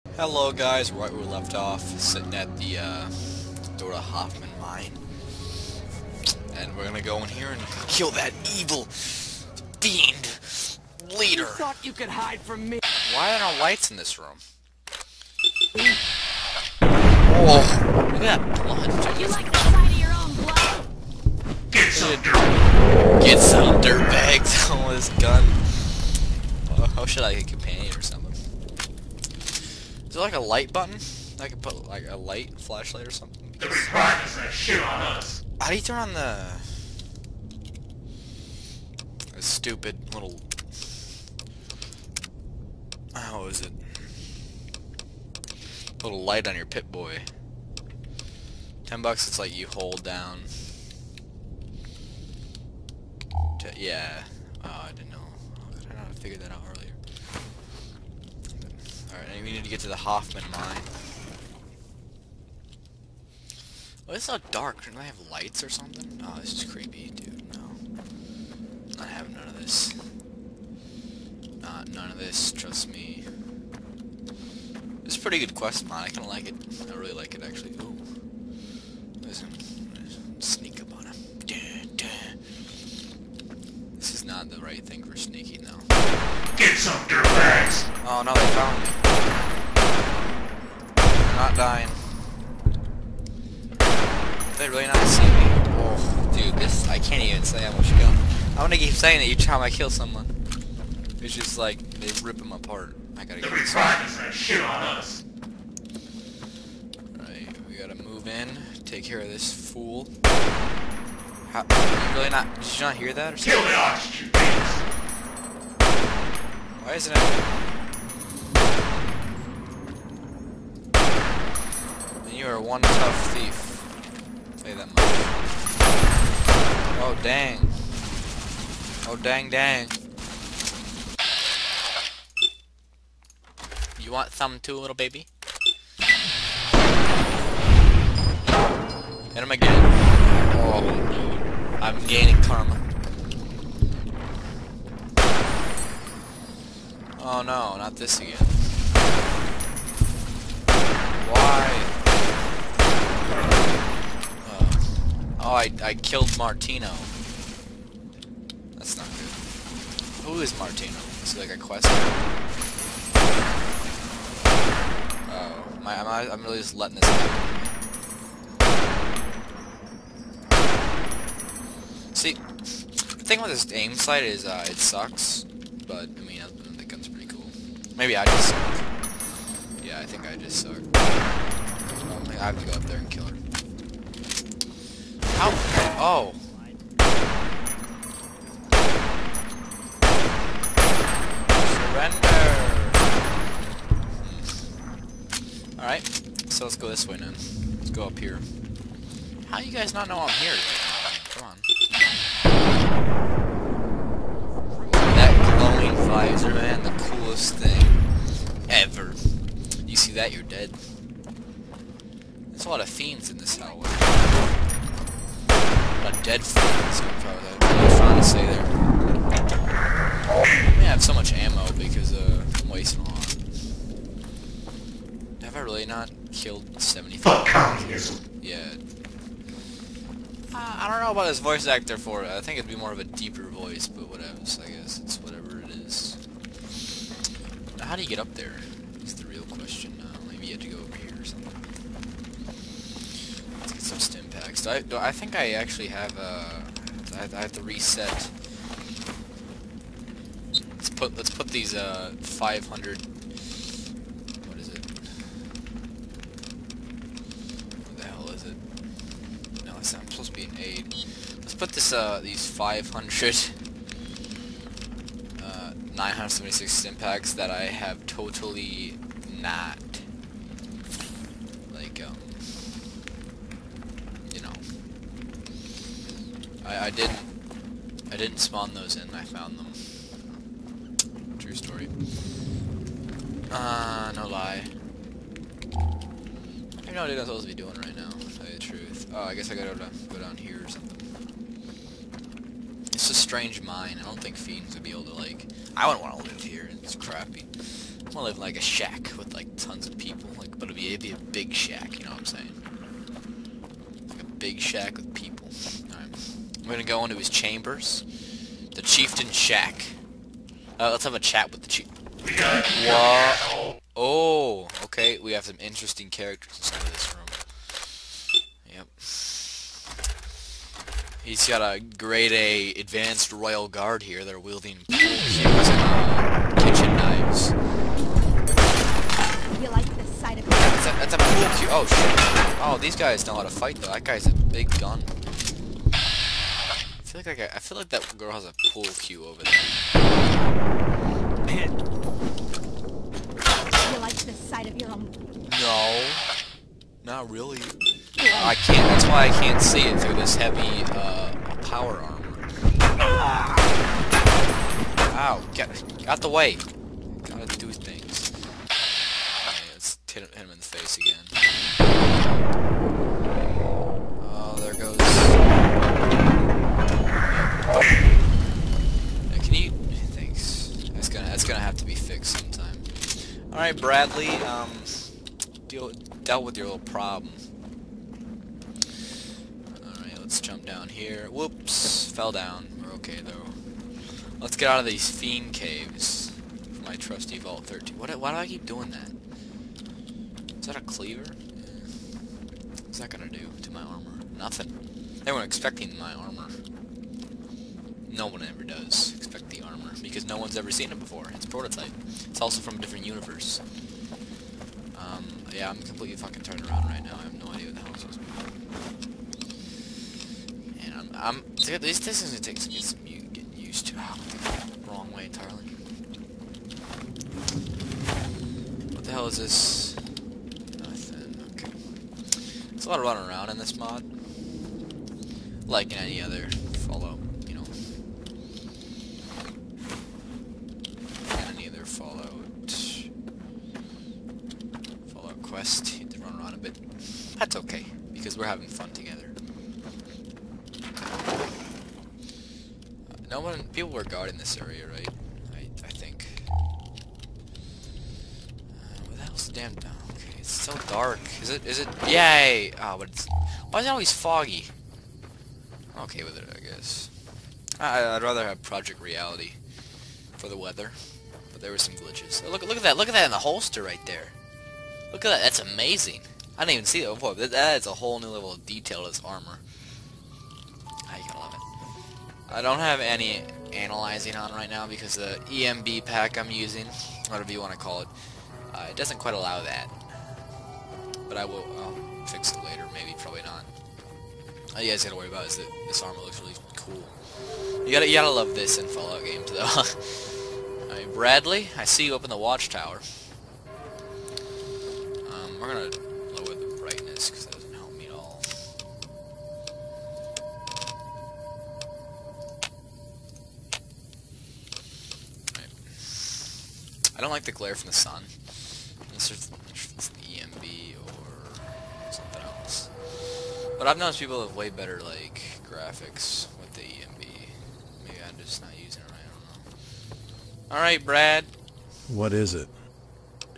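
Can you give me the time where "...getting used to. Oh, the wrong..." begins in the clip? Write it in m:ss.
6:53.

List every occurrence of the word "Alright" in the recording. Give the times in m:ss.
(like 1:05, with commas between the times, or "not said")
0:59, 1:47, 6:13, 6:19, 8:10, 8:40.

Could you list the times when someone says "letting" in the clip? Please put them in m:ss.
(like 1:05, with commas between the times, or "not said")
2:46.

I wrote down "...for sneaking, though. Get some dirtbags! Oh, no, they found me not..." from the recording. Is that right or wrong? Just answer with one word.
right.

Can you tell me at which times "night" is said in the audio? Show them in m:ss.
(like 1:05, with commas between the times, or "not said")
not said.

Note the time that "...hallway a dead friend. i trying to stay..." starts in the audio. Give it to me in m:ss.
3:33.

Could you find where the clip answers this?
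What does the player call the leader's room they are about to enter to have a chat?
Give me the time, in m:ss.
5:08.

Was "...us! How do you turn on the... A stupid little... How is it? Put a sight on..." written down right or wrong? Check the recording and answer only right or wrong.
wrong.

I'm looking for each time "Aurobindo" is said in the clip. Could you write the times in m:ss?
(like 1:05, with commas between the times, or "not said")
not said.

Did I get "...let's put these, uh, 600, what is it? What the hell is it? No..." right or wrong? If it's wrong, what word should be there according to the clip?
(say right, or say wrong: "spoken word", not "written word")
wrong: "500", not "600".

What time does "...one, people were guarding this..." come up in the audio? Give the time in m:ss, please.
7:23.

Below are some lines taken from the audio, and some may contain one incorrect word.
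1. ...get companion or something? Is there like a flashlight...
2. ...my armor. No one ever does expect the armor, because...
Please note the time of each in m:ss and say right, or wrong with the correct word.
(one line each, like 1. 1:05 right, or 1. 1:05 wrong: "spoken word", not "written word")
1. 0:27 wrong: "light", not "flashlight"
2. 6:35 right.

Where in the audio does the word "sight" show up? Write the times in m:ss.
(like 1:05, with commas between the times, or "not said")
0:19, 2:53, 5:30, 5:44.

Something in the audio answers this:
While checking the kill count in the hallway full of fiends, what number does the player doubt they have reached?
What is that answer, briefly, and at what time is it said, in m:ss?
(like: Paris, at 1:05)
75, at 3:46.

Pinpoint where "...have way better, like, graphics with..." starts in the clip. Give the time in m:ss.
8:34.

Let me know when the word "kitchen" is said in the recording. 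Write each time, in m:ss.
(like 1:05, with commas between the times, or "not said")
5:26.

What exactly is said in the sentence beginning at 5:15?
We have some interesting characters inside of this room.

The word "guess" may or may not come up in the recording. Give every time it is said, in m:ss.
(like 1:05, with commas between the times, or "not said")
3:54, 4:49, 7:36.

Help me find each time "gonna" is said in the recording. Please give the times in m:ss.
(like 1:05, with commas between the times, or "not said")
0:06, 1:38, 5:06, 6:33, 6:52, 8:15.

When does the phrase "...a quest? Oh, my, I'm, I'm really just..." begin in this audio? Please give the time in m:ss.
2:41.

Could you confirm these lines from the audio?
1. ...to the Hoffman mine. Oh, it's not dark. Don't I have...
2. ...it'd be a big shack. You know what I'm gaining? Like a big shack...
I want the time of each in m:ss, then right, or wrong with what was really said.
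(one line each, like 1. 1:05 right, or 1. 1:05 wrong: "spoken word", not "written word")
1. 0:59 right
2. 5:00 wrong: "saying", not "gaining".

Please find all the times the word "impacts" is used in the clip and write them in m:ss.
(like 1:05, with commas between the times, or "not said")
4:26.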